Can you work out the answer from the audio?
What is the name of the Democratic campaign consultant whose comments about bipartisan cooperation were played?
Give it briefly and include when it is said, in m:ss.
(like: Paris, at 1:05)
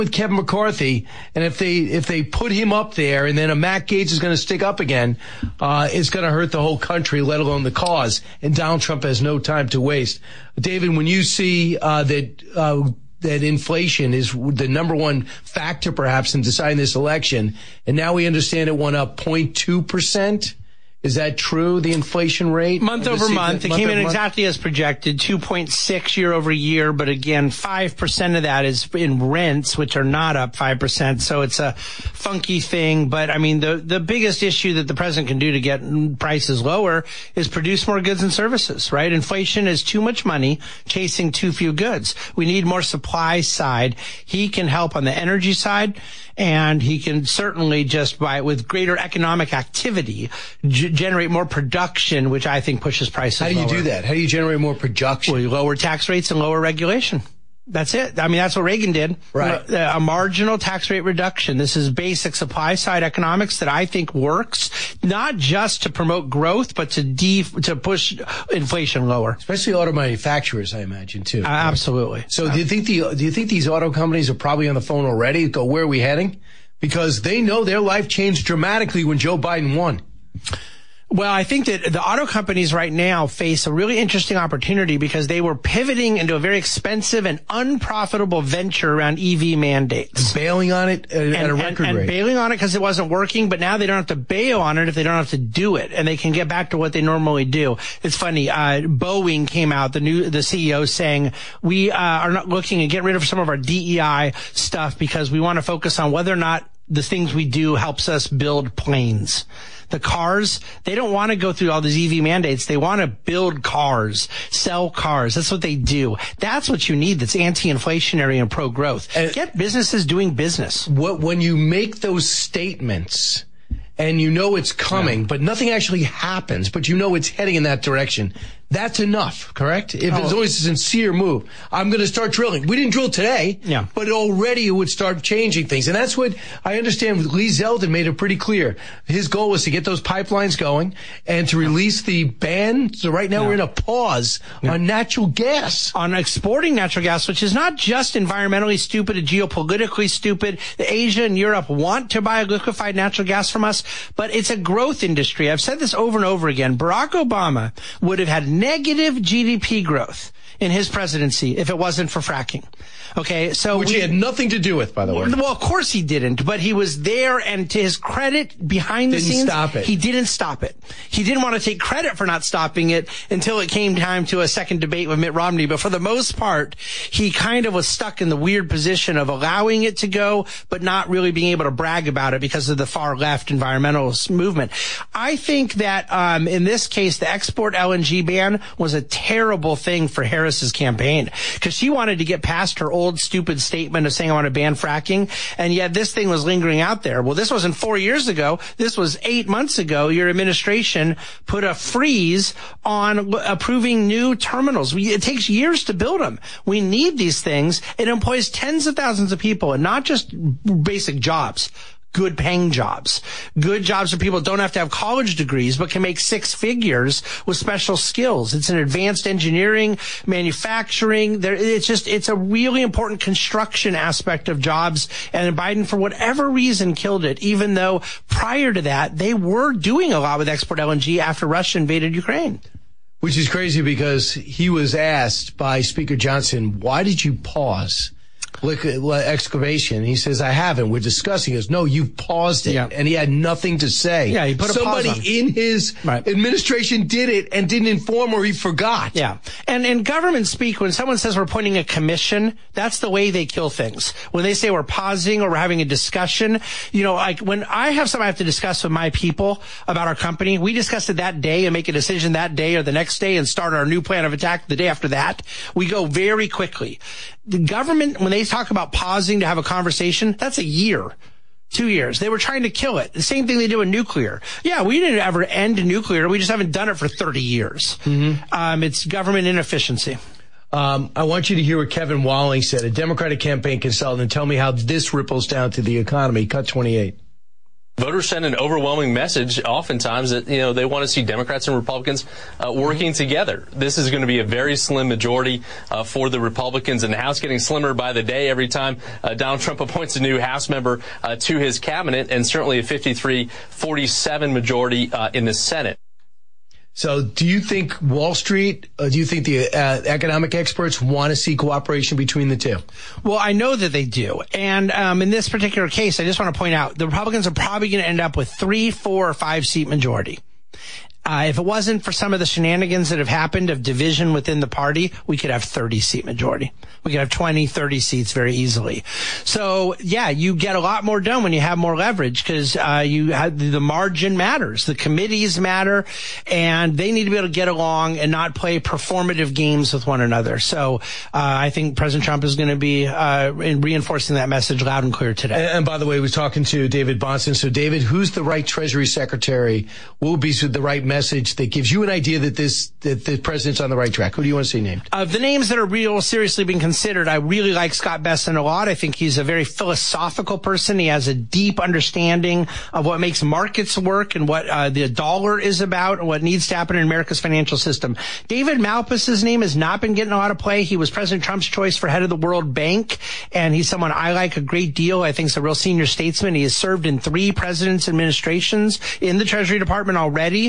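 Kevin Walling, at 4:41.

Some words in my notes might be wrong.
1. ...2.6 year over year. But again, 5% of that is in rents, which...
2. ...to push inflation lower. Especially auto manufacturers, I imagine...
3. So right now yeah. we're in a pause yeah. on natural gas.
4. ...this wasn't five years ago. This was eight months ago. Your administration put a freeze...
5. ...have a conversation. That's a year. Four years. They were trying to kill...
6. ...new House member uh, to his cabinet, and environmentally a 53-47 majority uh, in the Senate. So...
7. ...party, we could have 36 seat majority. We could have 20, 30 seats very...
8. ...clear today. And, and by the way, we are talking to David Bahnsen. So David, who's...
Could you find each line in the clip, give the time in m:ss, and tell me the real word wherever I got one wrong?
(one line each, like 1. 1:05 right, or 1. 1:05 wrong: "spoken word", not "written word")
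1. 0:25 right
2. 1:07 right
3. 2:22 right
4. 3:17 wrong: "four", not "five"
5. 4:29 wrong: "Two", not "Four"
6. 5:00 wrong: "certainly", not "environmentally"
7. 5:24 wrong: "30", not "36"
8. 5:45 right.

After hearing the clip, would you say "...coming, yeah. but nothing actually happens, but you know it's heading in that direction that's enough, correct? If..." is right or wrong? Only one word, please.
right.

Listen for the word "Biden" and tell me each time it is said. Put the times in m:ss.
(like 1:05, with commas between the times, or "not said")
1:19, 3:45.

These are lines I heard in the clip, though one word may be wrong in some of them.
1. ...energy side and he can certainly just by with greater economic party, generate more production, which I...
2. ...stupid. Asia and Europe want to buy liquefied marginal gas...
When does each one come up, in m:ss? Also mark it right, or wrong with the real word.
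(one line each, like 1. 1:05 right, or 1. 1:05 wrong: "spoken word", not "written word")
1. 0:45 wrong: "activity", not "party"
2. 2:30 wrong: "natural", not "marginal".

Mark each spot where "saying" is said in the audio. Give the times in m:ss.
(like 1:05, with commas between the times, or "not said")
1:40, 3:14.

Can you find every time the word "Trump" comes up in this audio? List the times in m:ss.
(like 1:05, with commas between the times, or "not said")
0:08, 4:59, 5:42, 6:11.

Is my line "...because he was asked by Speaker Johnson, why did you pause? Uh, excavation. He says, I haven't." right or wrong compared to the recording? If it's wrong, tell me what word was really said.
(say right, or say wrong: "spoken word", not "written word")
right.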